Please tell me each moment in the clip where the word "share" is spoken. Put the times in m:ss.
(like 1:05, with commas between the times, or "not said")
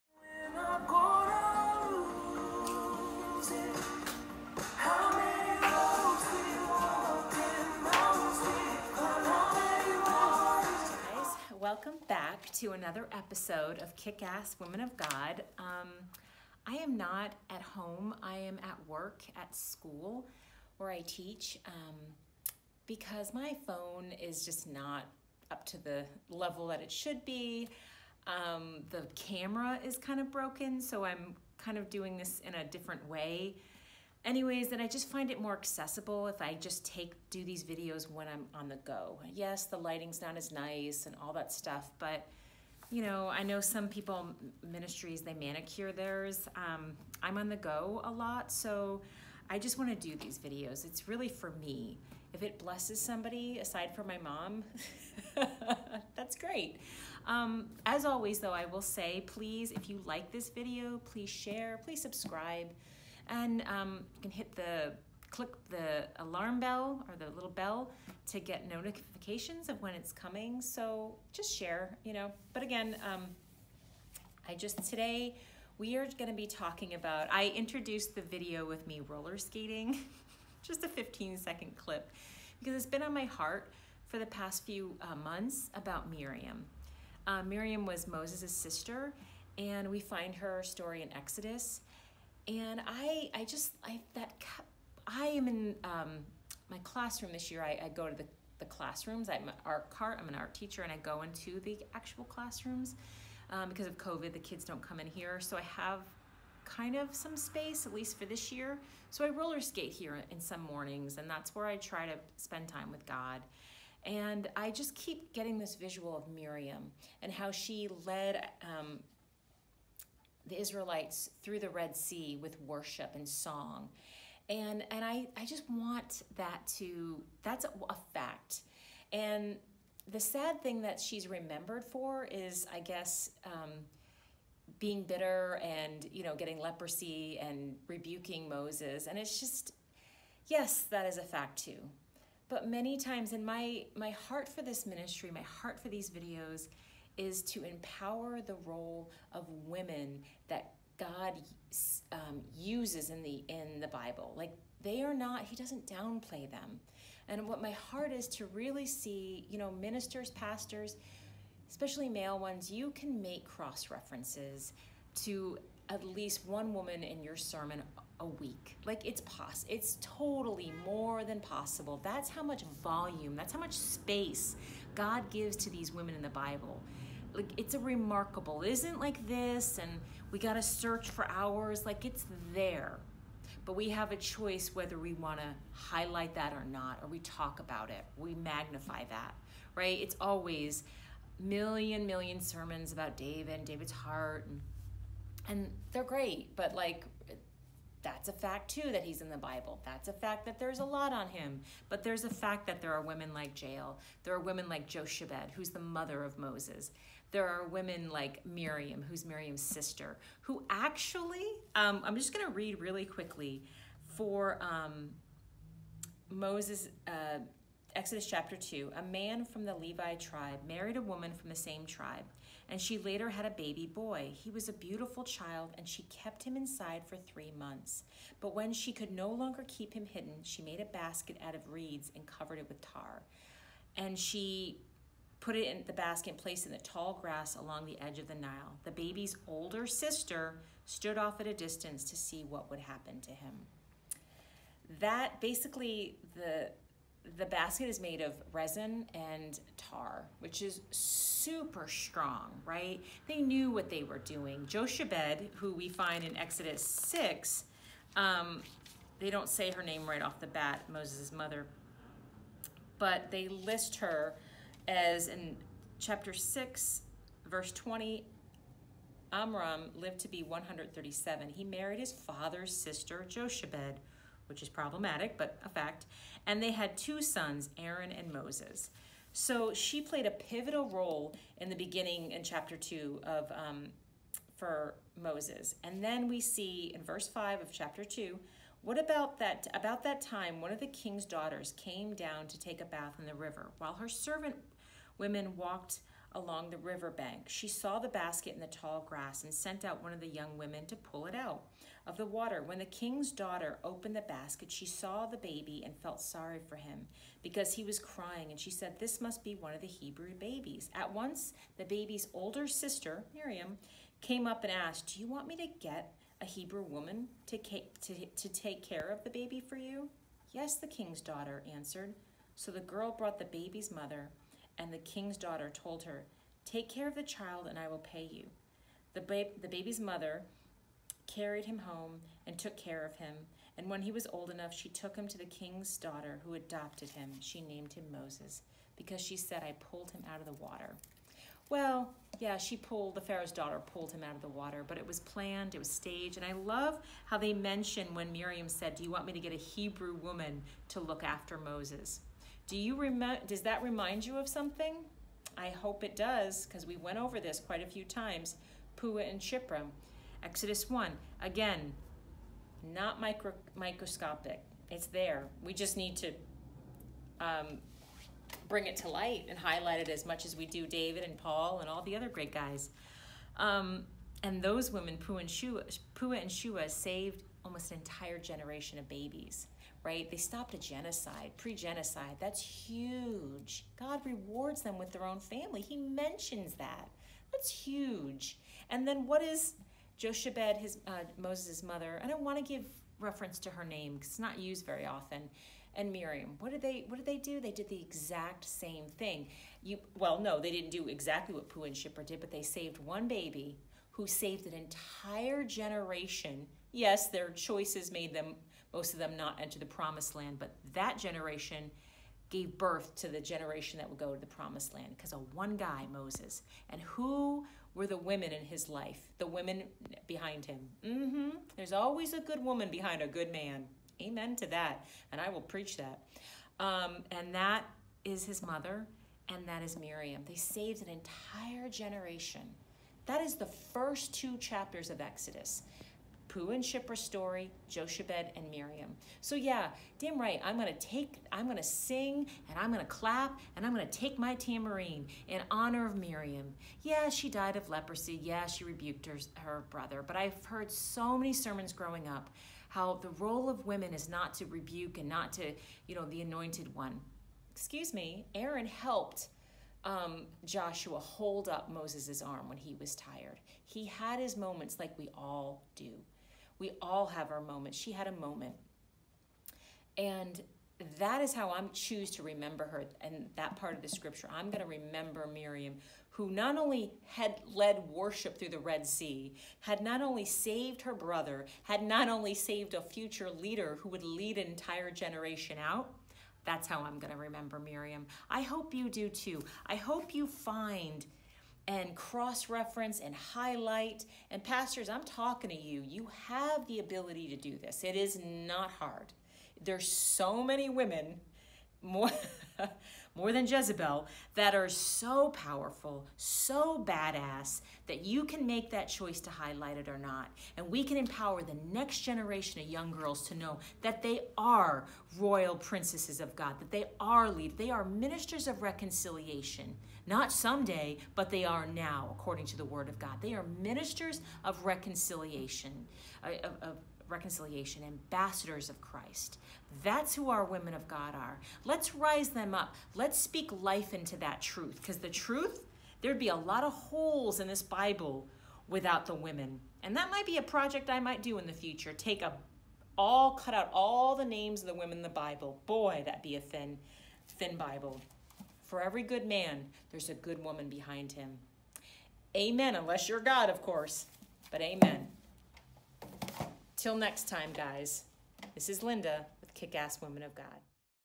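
1:01, 1:11.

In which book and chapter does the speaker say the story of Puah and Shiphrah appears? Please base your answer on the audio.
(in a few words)
Exodus 1.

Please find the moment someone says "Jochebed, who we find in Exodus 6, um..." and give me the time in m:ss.
4:14.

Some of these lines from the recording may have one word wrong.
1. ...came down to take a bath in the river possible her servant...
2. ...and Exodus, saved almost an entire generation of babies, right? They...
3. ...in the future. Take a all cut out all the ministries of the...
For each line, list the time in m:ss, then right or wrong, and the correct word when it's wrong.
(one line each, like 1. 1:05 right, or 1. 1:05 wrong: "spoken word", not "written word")
1. 4:51 wrong: "while", not "possible"
2. 6:16 wrong: "Shua", not "Exodus"
3. 9:01 wrong: "names", not "ministries".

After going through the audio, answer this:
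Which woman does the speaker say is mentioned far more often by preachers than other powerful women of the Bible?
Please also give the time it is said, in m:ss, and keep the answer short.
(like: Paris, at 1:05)
Jezebel, at 8:23.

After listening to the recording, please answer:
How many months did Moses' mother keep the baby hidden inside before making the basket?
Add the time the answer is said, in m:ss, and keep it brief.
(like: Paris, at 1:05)
3, at 3:47.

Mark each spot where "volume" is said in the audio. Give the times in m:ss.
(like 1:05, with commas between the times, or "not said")
2:52.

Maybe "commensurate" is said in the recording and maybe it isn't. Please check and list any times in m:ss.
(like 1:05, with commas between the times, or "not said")
not said.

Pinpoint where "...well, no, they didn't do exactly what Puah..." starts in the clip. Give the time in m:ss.
6:40.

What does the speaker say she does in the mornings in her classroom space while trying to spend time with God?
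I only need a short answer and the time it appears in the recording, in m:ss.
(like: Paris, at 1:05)
Roller skate, at 1:49.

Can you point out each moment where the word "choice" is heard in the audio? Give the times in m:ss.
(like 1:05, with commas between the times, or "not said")
3:04, 6:47, 8:29.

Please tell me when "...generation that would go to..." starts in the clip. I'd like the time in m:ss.
6:53.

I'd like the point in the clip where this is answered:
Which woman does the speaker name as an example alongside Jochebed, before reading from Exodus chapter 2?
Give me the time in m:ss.
3:23.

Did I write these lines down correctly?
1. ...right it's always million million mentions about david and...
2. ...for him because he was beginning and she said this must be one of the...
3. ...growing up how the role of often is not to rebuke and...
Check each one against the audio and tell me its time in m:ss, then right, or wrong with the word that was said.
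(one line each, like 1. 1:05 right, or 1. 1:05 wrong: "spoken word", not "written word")
1. 3:09 wrong: "sermons", not "mentions"
2. 5:06 wrong: "crying", not "beginning"
3. 7:31 wrong: "women", not "often".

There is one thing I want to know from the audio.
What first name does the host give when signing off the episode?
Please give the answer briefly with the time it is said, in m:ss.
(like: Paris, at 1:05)
Linda, at 9:19.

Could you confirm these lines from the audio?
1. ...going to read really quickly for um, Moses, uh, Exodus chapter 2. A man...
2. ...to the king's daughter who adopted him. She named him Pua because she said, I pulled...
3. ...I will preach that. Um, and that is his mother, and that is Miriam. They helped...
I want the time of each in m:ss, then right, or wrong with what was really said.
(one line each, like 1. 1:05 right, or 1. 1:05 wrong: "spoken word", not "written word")
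1. 3:32 right
2. 5:35 wrong: "Moses", not "Pua"
3. 7:05 wrong: "saved", not "helped".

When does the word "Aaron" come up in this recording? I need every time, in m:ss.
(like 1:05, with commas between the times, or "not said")
4:37, 7:38.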